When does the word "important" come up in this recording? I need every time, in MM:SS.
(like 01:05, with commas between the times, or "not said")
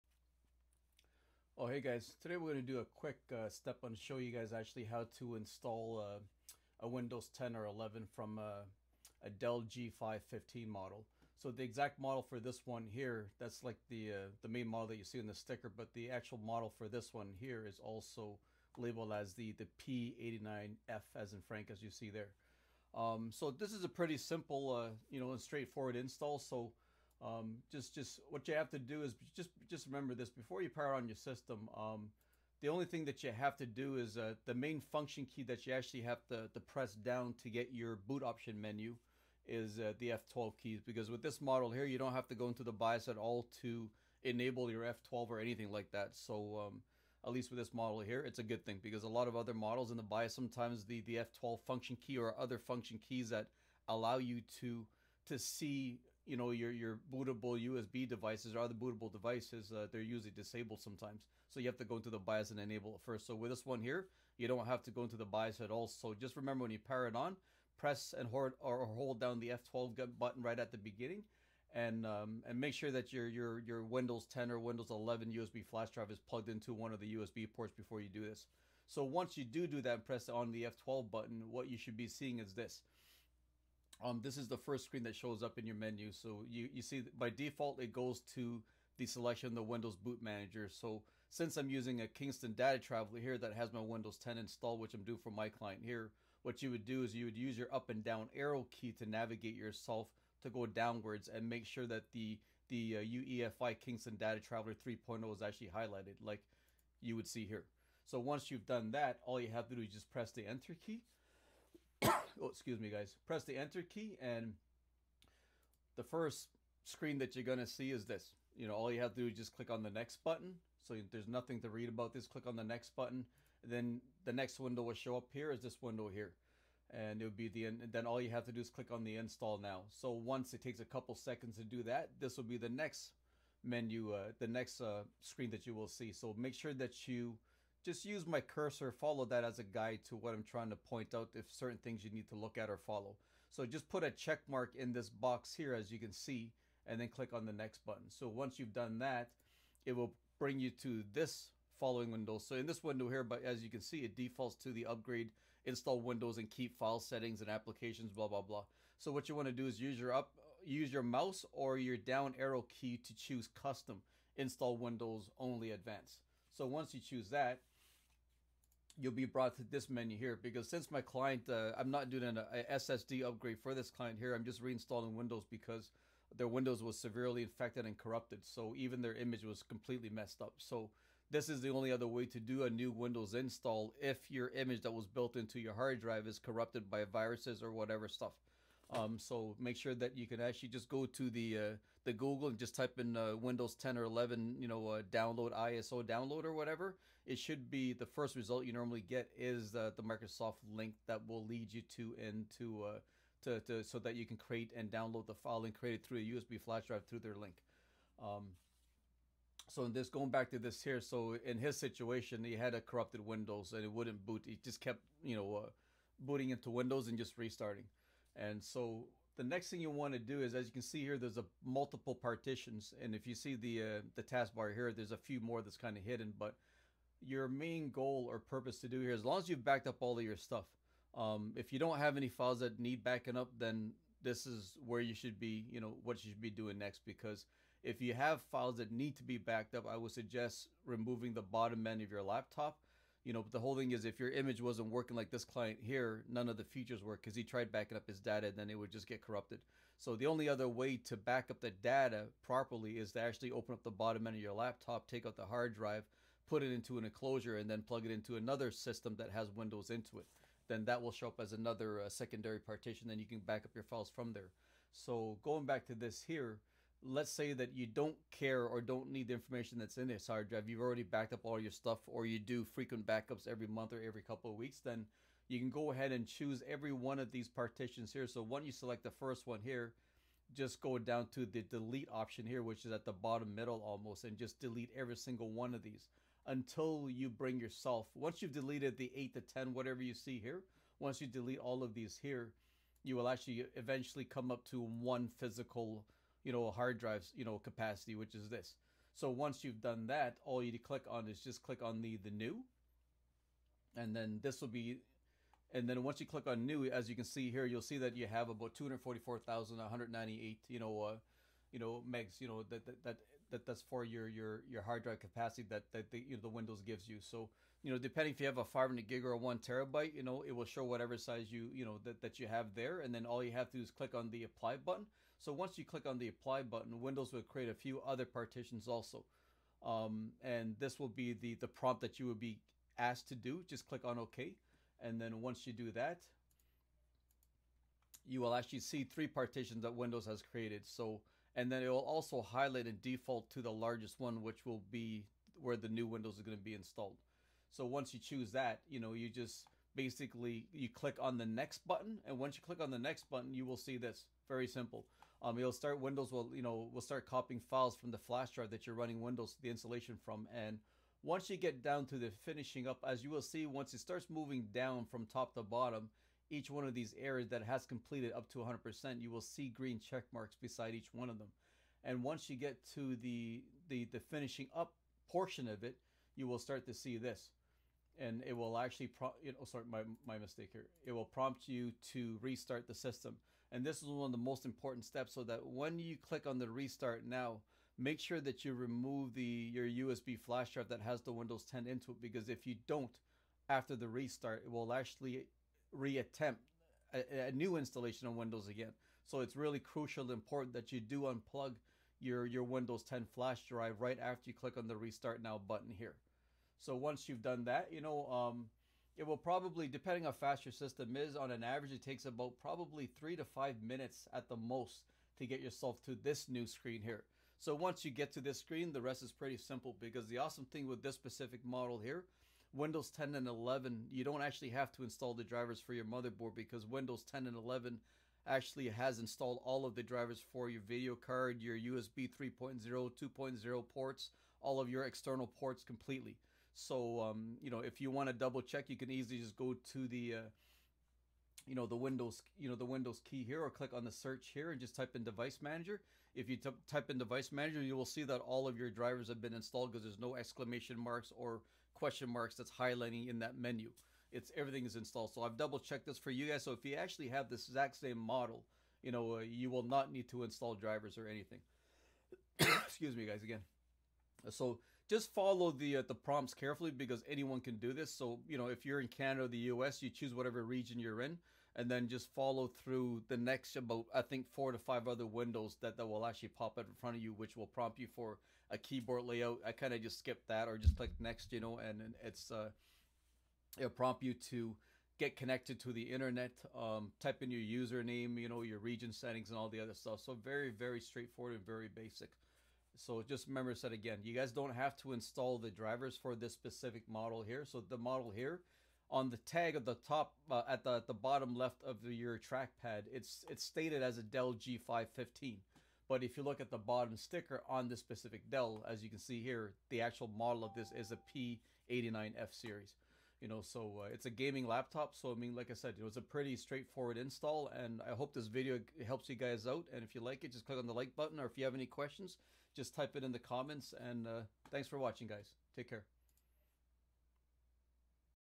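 06:24, 06:40.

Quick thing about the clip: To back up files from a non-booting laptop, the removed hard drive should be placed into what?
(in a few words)
An enclosure.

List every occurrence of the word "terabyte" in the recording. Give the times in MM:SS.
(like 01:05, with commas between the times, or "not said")
05:19.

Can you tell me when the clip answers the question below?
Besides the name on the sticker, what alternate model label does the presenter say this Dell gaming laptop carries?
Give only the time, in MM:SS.
00:19.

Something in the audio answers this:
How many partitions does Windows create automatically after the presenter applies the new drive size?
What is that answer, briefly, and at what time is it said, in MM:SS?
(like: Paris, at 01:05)
3, at 05:39.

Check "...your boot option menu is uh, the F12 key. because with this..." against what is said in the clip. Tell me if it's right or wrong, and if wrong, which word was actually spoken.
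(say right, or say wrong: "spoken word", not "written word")
right.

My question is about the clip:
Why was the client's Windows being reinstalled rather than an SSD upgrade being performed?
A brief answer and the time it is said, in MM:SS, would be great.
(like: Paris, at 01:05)
Severely infected and corrupted, at 02:56.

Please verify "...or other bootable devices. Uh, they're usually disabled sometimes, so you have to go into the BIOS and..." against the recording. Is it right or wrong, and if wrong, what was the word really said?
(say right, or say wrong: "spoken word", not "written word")
right.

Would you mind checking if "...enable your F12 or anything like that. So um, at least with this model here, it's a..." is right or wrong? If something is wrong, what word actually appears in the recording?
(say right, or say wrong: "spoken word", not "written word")
right.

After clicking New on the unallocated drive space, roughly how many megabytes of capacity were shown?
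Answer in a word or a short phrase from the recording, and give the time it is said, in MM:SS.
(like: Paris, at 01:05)
244,198, at 05:08.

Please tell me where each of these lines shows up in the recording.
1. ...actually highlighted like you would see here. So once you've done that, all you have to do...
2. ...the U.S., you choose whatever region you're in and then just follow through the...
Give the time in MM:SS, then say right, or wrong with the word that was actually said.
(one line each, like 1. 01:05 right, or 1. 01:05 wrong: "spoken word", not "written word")
1. 01:45 right
2. 07:49 right.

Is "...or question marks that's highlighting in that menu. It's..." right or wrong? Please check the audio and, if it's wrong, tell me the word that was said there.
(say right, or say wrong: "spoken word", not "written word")
right.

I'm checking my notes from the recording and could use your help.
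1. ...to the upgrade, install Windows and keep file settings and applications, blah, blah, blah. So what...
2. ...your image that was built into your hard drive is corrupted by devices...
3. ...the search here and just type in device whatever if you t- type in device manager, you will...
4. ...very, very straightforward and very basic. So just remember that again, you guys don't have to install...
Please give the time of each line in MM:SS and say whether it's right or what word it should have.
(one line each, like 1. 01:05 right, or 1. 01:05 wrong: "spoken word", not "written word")
1. 02:34 right
2. 03:04 wrong: "viruses", not "devices"
3. 07:24 wrong: "manager", not "whatever"
4. 08:10 right.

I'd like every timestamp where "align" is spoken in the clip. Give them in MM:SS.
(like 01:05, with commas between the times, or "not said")
not said.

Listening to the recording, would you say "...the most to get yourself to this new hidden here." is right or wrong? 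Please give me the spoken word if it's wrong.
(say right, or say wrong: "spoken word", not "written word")
wrong: "screen", not "hidden".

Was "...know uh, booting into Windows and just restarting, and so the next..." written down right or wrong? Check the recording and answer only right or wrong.
right.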